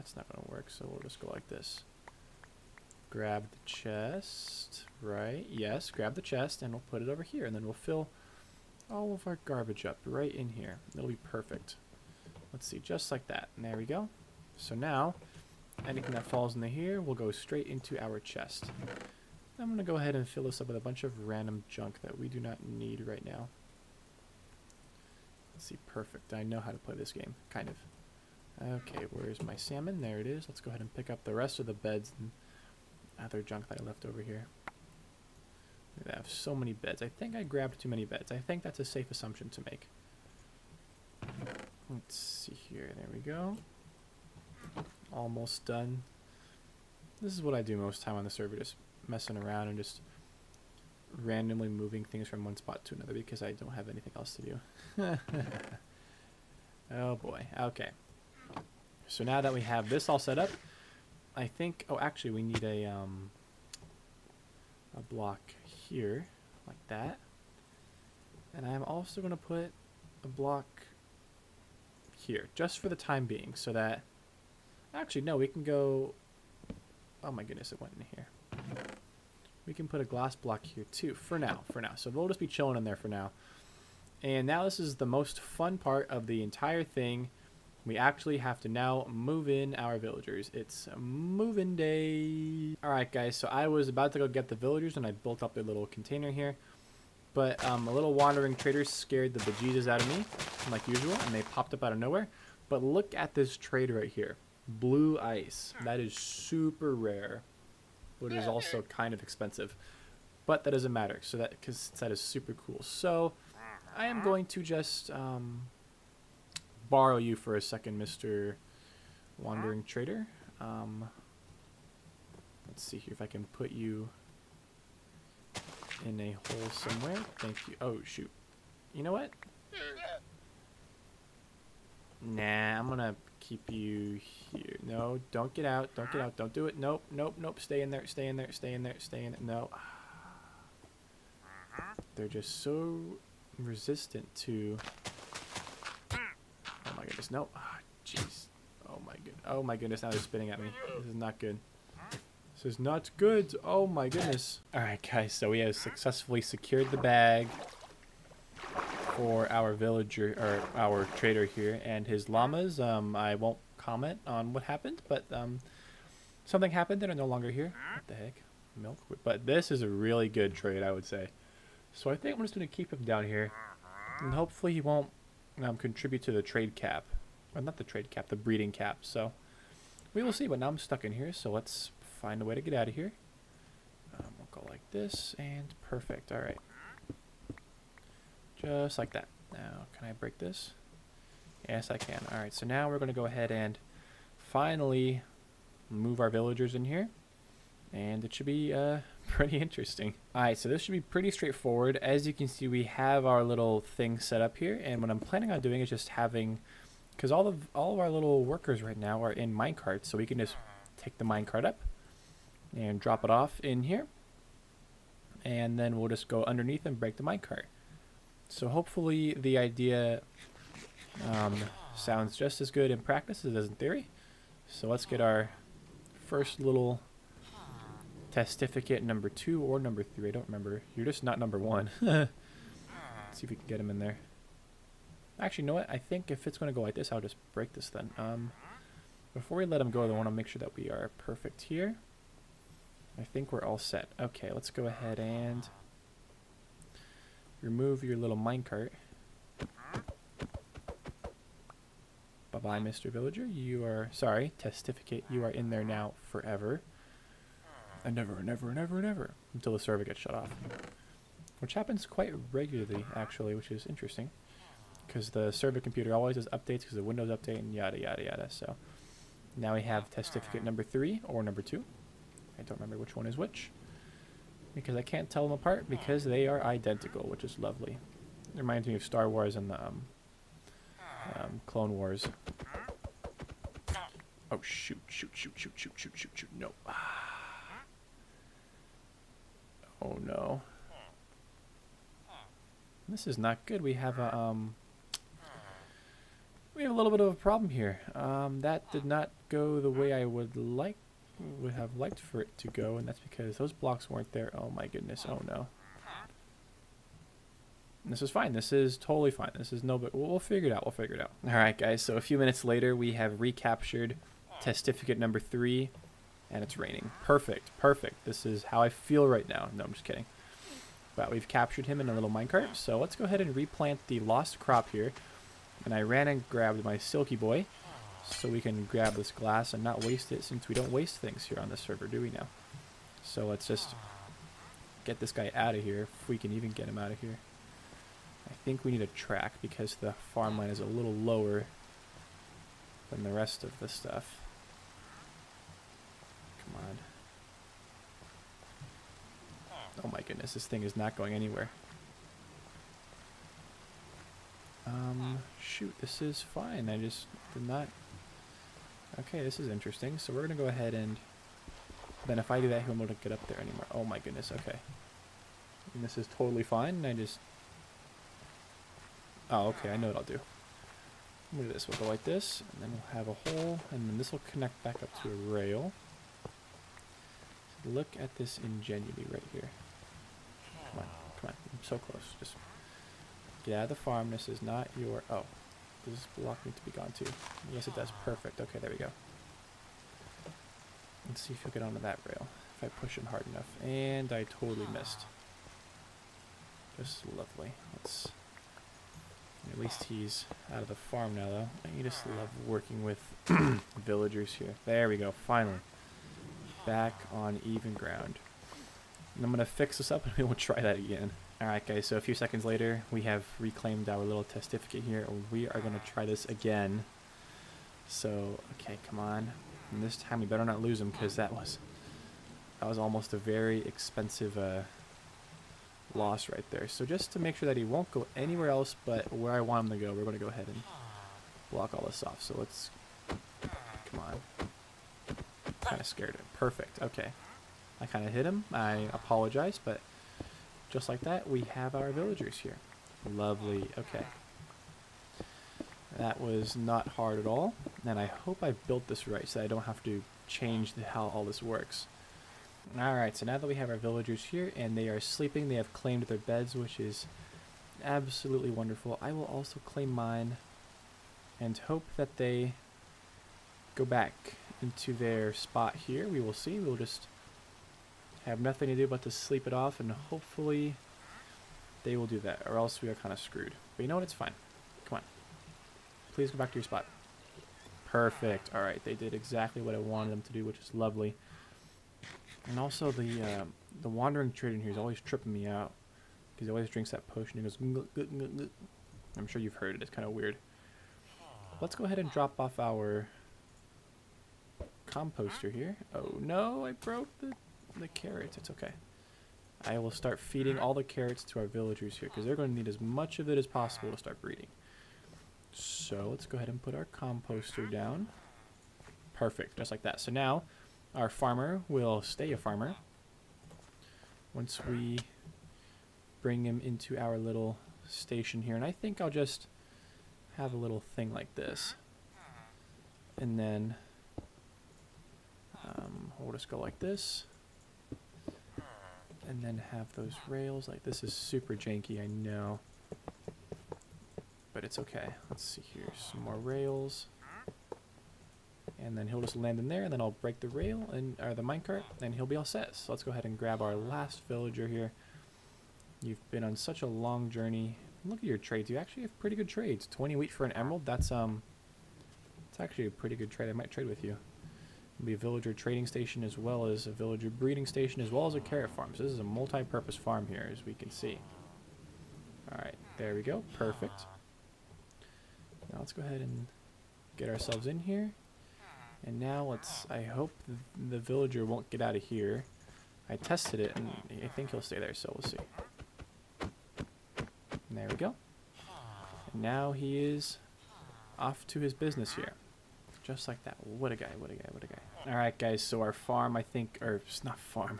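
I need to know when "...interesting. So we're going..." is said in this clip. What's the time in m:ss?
5:59.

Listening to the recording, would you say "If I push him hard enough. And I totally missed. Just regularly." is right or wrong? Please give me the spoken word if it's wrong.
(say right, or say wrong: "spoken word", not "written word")
wrong: "lovely", not "regularly".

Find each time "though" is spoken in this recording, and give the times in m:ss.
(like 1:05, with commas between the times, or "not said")
6:41.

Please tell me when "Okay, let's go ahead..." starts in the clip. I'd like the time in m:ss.
4:04.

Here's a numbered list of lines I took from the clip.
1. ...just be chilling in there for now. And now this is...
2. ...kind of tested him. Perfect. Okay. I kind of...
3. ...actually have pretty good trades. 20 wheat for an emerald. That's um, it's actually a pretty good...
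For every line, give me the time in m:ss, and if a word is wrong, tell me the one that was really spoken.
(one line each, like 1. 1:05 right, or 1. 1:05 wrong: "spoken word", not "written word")
1. 1:22 right
2. 7:15 wrong: "scared", not "tested"
3. 9:08 right.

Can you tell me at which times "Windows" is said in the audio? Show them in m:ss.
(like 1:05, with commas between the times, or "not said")
4:27.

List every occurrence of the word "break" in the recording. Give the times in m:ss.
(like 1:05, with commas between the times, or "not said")
3:10, 3:37, 3:57, 9:00.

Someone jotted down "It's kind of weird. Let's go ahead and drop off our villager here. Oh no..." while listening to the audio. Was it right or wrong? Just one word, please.
wrong.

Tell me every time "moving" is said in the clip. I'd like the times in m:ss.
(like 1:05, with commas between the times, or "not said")
0:51, 1:30.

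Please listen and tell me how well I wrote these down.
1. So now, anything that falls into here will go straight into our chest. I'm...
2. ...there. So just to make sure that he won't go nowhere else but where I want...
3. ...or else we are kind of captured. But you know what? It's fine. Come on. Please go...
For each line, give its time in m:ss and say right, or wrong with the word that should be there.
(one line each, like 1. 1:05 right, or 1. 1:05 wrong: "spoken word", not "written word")
1. 0:14 right
2. 7:06 wrong: "anywhere", not "nowhere"
3. 7:52 wrong: "screwed", not "captured".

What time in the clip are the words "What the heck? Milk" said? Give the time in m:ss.
2:47.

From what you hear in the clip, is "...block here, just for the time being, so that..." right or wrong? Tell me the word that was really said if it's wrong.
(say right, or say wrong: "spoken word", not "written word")
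right.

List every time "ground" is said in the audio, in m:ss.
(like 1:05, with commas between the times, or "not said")
6:47.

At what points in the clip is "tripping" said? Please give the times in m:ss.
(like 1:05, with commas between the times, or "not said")
8:05.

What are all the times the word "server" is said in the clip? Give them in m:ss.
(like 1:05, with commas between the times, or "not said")
0:48, 4:19, 4:25, 5:31.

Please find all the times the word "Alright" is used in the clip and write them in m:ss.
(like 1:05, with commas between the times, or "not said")
2:34, 6:51, 7:32, 9:22.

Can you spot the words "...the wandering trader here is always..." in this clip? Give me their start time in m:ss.
8:04.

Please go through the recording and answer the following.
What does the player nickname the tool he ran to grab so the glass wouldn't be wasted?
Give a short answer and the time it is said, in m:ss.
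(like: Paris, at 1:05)
silky boy, at 5:26.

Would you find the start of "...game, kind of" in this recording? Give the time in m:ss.
0:27.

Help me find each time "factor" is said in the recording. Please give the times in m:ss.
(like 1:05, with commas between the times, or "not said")
not said.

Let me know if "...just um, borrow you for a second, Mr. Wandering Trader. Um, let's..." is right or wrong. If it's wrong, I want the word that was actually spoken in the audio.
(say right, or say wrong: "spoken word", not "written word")
right.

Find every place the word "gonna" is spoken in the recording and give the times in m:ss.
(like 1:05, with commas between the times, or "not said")
2:12, 6:11.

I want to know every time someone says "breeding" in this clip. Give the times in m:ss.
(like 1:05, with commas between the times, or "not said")
2:58, 8:24, 9:17.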